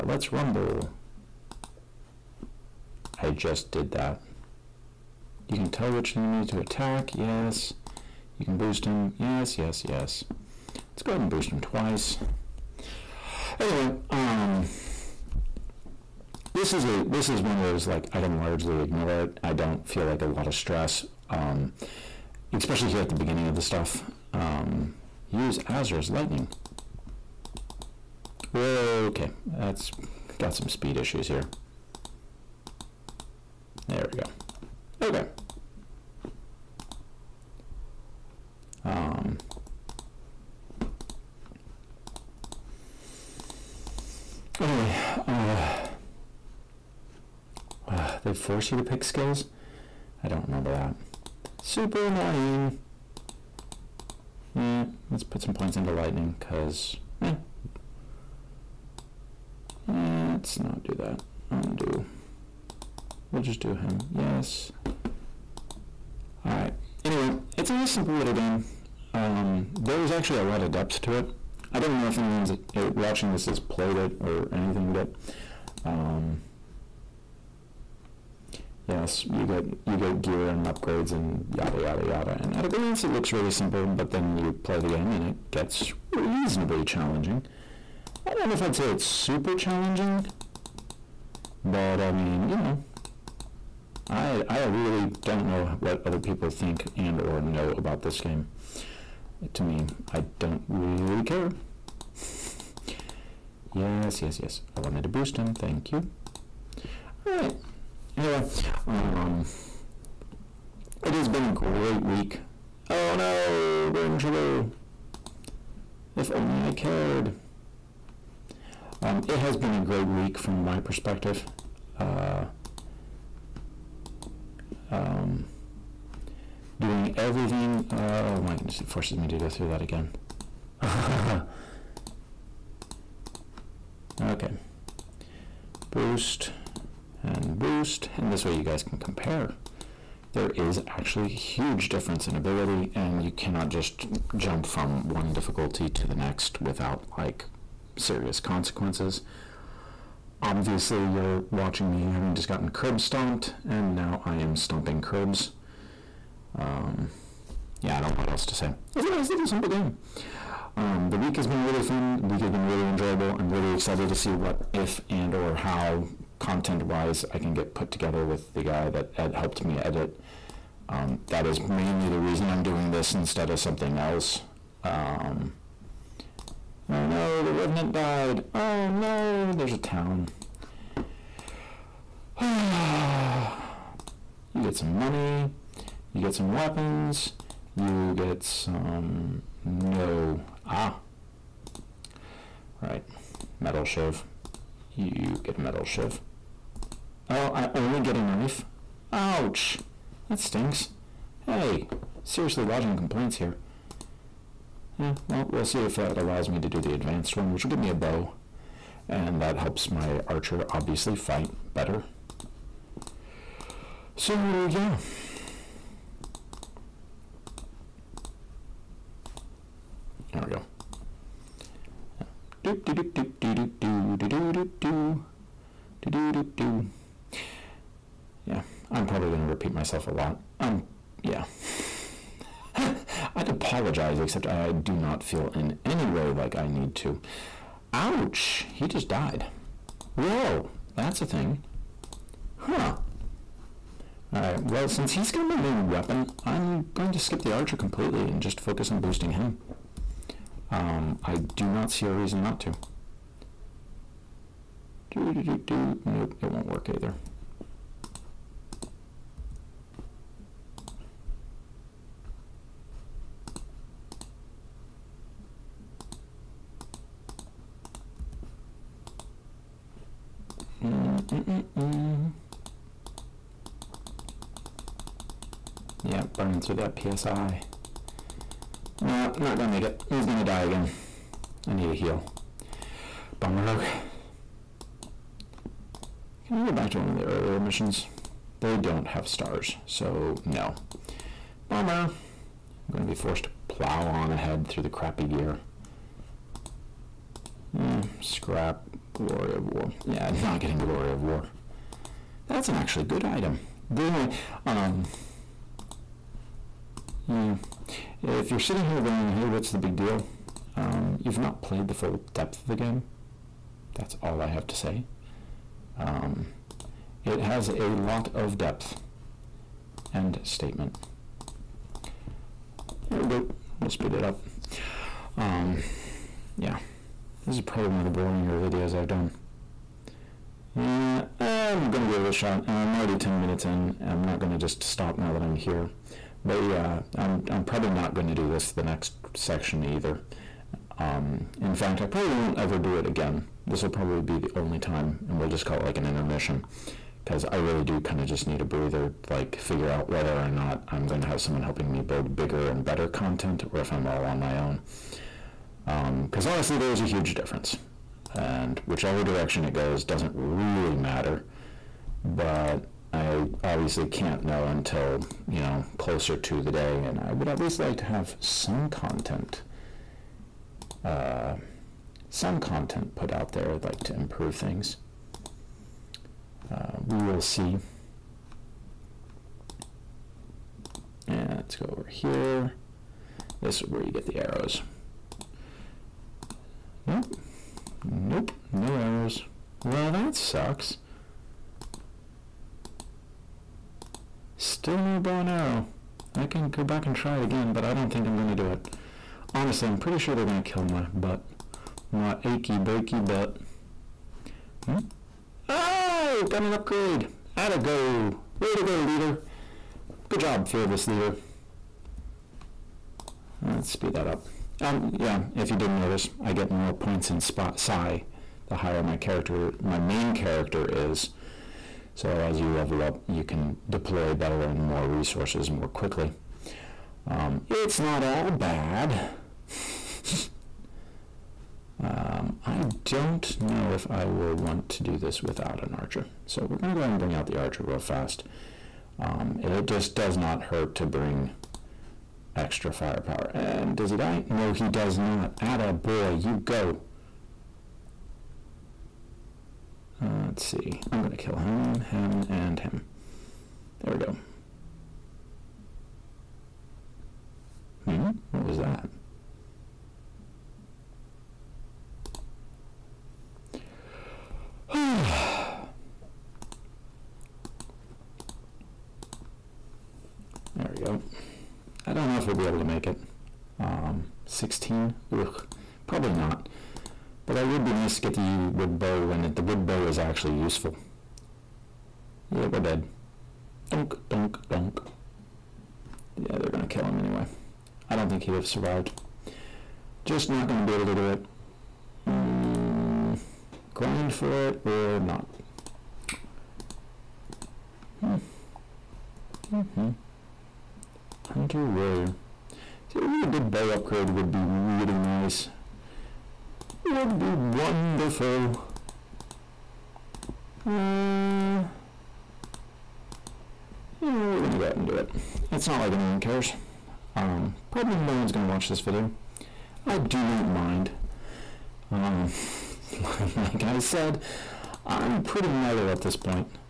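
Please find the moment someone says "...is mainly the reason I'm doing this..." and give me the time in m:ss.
2:51.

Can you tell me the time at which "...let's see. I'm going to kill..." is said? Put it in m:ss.
7:30.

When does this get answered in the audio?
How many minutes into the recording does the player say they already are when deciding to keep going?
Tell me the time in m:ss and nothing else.
5:33.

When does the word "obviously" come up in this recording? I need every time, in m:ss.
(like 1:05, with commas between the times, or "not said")
2:30, 3:30, 6:03.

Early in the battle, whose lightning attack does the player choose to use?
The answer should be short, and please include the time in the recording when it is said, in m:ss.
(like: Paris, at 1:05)
Azra, at 0:25.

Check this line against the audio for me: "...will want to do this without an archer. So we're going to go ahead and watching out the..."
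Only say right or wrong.
wrong.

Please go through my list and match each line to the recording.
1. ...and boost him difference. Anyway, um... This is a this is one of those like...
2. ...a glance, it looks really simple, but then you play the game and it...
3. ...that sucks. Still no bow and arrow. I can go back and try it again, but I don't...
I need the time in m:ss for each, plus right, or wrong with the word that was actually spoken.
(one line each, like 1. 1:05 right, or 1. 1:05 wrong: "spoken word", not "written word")
1. 0:11 wrong: "twice", not "difference"
2. 1:22 right
3. 6:30 right.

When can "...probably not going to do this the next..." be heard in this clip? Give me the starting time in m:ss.
5:37.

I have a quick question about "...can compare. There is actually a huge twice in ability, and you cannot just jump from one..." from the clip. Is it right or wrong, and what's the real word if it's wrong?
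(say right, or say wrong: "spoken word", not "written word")
wrong: "difference", not "twice".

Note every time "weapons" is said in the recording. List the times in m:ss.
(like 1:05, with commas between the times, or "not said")
3:06, 4:05.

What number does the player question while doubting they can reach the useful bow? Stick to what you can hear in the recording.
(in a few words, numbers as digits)
16.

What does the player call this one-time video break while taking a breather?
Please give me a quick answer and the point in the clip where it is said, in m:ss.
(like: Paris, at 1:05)
An intermission, at 5:46.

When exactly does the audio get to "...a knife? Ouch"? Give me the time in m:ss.
3:18.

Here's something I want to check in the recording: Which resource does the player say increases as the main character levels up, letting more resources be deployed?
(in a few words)
Spot psi.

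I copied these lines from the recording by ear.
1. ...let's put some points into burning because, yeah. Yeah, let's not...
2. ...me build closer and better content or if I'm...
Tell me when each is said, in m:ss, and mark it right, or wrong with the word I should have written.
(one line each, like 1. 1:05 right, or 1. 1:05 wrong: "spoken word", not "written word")
1. 0:55 wrong: "lightning", not "burning"
2. 5:51 wrong: "bigger", not "closer".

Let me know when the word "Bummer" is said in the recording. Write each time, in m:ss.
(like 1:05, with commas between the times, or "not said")
4:43, 4:51.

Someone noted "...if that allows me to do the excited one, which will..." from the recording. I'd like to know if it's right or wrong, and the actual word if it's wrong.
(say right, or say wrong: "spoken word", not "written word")
wrong: "advanced", not "excited".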